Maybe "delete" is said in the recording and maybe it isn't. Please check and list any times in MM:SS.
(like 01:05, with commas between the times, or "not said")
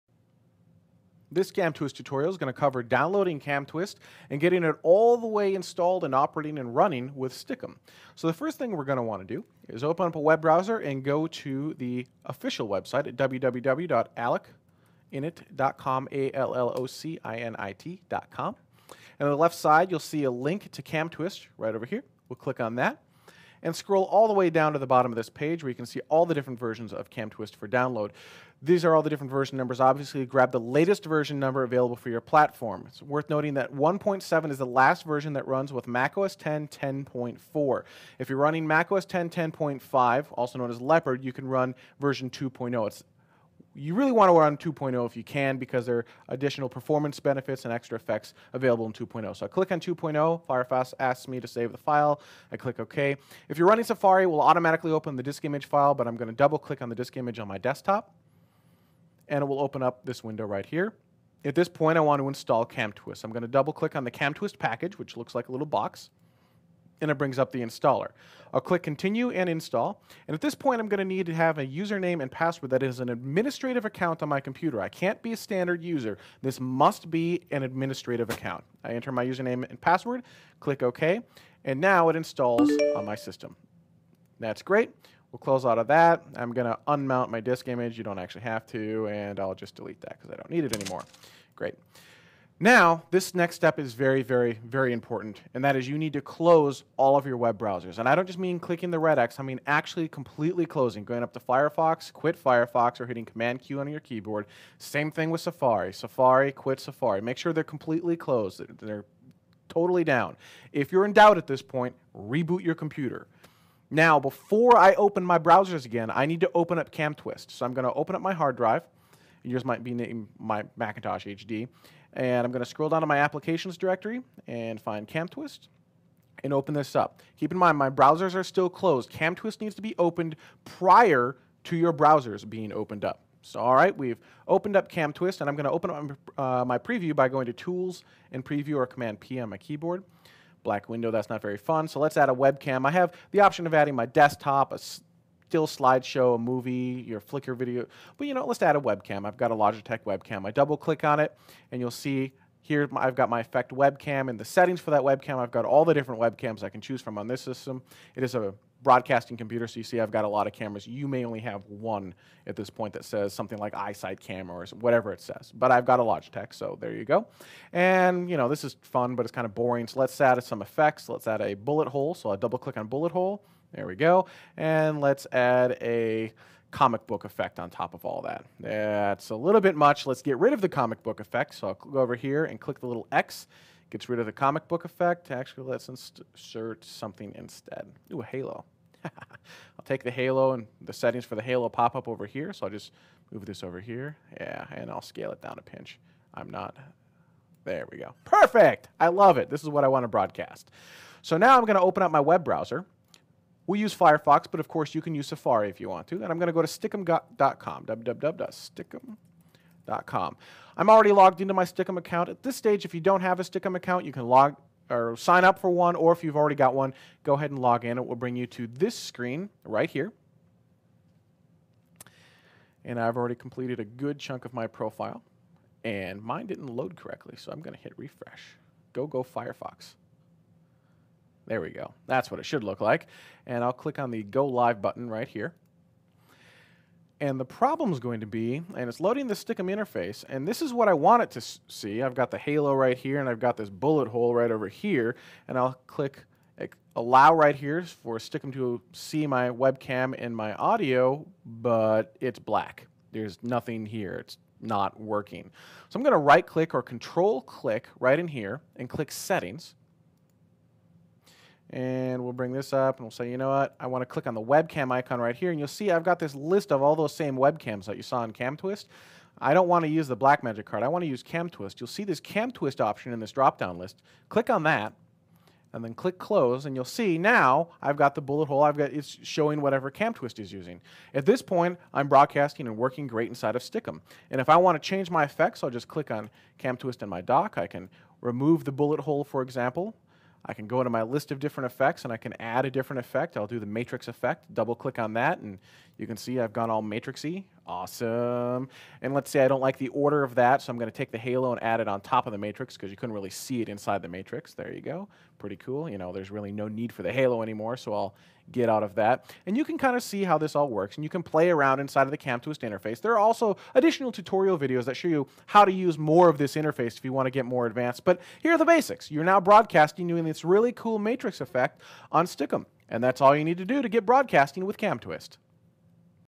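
01:29.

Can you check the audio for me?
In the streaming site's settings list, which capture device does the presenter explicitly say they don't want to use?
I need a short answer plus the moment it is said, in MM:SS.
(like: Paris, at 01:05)
Blackmagic card, at 04:30.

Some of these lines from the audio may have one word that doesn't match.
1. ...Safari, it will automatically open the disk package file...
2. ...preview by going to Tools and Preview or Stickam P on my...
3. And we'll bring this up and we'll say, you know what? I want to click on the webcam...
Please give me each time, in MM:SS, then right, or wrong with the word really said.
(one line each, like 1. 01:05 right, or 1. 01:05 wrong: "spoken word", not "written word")
1. 00:53 wrong: "image", not "package"
2. 02:16 wrong: "Command", not "Stickam"
3. 04:21 right.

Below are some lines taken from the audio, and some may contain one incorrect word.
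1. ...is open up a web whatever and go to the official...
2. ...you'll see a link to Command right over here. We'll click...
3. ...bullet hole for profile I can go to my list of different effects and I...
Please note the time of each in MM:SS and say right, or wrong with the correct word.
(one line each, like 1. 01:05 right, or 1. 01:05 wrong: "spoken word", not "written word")
1. 00:09 wrong: "browser", not "whatever"
2. 00:19 wrong: "CamTwist", not "Command"
3. 04:48 wrong: "example", not "profile".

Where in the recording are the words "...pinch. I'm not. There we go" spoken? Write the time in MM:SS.
03:15.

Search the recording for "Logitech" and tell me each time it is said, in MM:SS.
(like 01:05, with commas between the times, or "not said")
02:29, 02:46.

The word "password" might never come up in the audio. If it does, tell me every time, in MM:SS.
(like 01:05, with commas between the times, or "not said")
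01:12, 01:19.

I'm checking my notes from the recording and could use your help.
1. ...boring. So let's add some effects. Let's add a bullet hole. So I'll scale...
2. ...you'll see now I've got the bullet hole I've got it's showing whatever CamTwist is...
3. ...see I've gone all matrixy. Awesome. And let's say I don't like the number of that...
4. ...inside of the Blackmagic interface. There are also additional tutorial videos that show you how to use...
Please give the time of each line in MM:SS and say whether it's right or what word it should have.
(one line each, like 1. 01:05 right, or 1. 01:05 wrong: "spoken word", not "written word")
1. 02:49 wrong: "double", not "scale"
2. 04:36 right
3. 04:56 wrong: "order", not "number"
4. 05:11 wrong: "CamTwist", not "Blackmagic".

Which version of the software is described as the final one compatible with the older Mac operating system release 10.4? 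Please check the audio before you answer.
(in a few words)
1.7.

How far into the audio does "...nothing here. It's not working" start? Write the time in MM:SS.
04:13.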